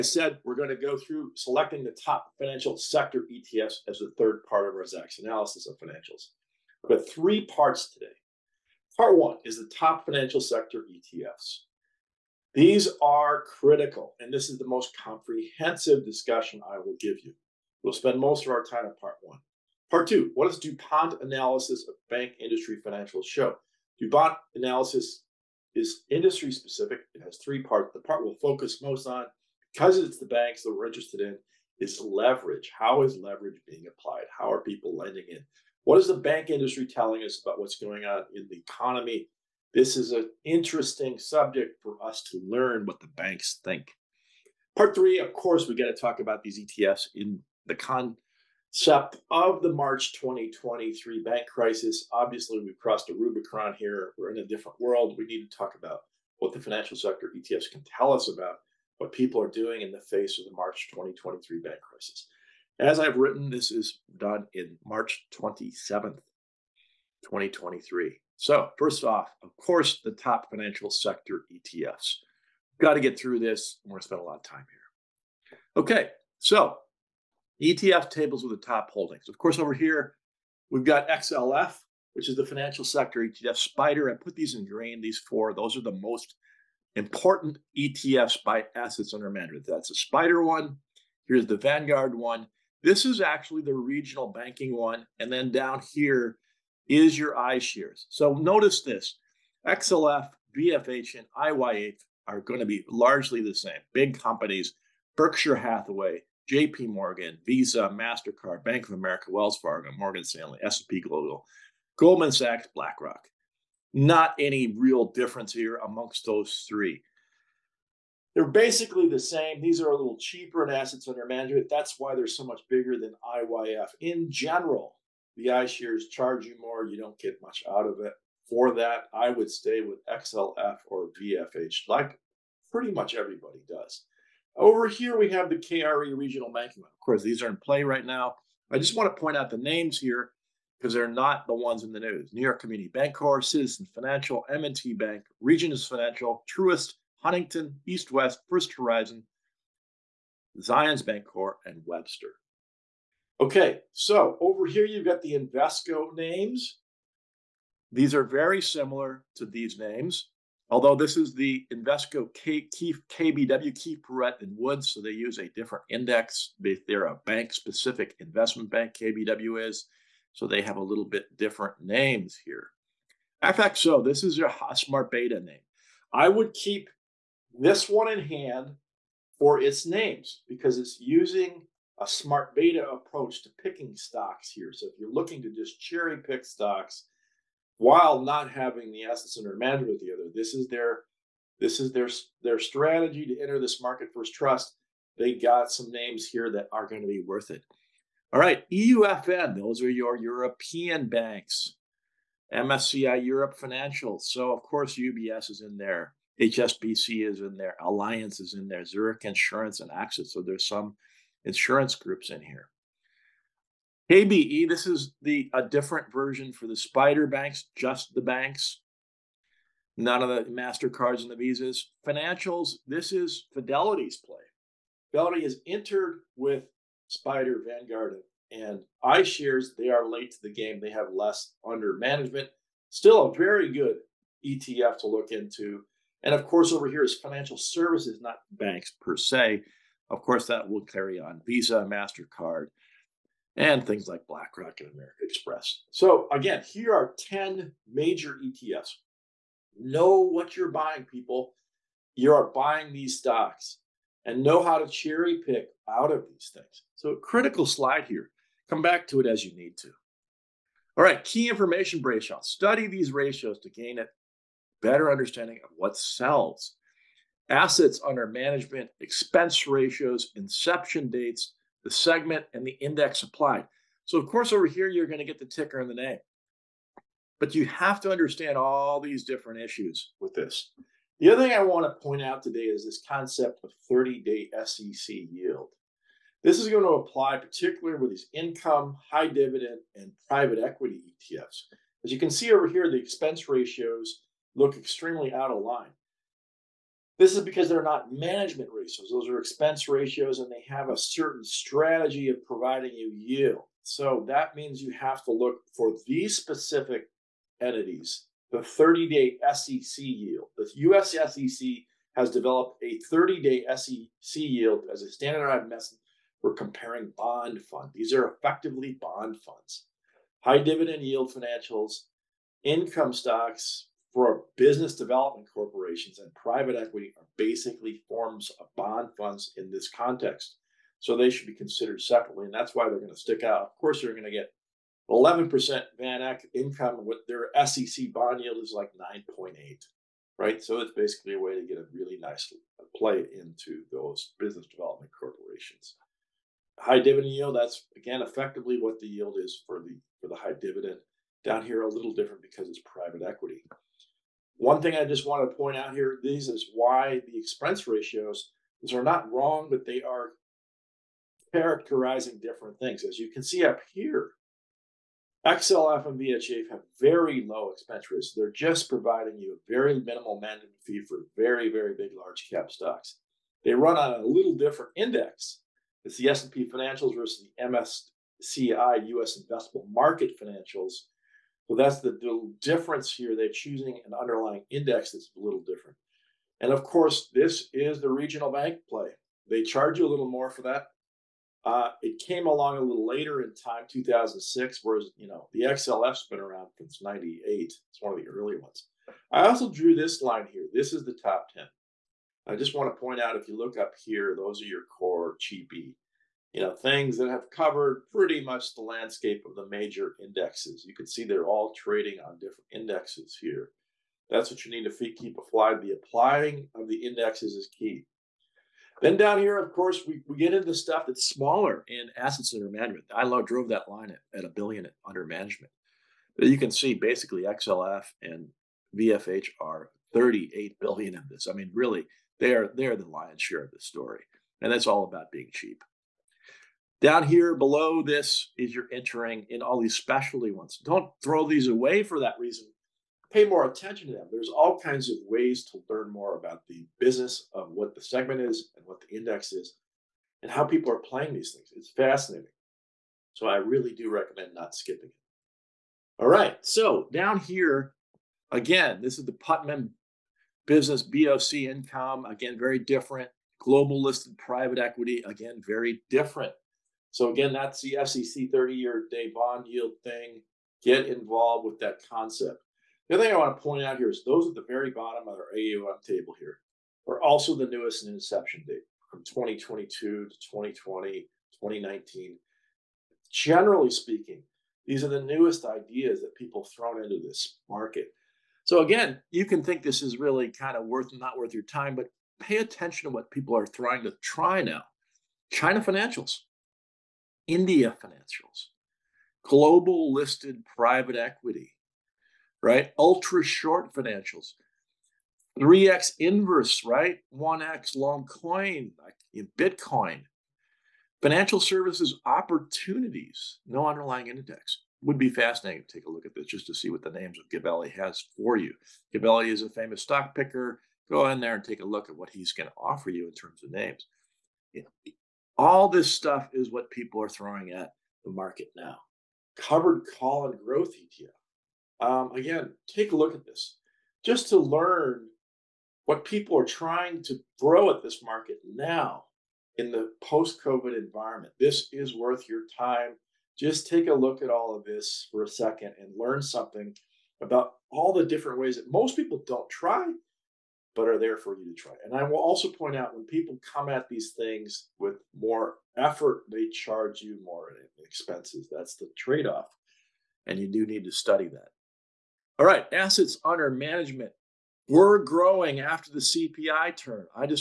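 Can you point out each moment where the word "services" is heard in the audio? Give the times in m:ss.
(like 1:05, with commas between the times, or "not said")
3:57, 8:31.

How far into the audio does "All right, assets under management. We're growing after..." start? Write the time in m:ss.
9:22.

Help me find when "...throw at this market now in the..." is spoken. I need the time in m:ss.
8:57.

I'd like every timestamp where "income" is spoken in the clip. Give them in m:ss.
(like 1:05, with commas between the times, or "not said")
4:48, 5:22, 5:36, 7:41.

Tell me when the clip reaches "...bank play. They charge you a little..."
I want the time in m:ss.
6:28.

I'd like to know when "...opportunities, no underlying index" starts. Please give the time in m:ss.
8:32.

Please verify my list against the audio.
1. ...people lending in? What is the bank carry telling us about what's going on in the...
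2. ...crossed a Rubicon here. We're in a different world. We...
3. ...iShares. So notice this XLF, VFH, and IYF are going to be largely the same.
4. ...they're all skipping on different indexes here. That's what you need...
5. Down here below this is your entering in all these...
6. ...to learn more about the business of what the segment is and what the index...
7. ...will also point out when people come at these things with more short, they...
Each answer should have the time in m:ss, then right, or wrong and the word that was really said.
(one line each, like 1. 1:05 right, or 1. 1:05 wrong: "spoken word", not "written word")
1. 0:34 wrong: "industry", not "carry"
2. 0:52 right
3. 1:37 right
4. 6:51 wrong: "trading", not "skipping"
5. 7:17 right
6. 7:25 right
7. 9:12 wrong: "effort", not "short".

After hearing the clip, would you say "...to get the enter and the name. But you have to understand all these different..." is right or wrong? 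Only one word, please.
wrong.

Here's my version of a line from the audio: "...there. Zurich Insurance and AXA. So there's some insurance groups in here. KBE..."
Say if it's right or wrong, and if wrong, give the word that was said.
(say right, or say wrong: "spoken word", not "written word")
right.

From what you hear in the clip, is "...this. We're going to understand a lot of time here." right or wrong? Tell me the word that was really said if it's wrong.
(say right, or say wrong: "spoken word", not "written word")
wrong: "spend", not "understand".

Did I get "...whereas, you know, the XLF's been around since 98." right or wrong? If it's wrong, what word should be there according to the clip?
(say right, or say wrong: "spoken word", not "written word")
right.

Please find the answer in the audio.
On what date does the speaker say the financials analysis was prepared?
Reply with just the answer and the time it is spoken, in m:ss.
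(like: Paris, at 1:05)
March 27th, 2023, at 1:04.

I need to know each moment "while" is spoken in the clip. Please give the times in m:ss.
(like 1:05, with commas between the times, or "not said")
3:07.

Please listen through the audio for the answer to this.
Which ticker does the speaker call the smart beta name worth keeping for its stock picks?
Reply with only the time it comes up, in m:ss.
2:53.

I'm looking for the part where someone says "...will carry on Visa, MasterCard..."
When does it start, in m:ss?
4:00.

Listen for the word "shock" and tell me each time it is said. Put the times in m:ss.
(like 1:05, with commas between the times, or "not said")
not said.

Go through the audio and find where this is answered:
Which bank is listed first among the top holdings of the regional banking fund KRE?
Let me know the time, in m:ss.
2:22.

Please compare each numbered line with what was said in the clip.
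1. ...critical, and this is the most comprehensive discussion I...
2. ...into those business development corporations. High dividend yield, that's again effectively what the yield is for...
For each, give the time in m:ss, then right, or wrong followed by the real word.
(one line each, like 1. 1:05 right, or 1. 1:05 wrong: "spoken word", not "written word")
1. 0:13 right
2. 5:43 right.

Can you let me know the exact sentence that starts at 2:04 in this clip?
In general, the iShares charge you more.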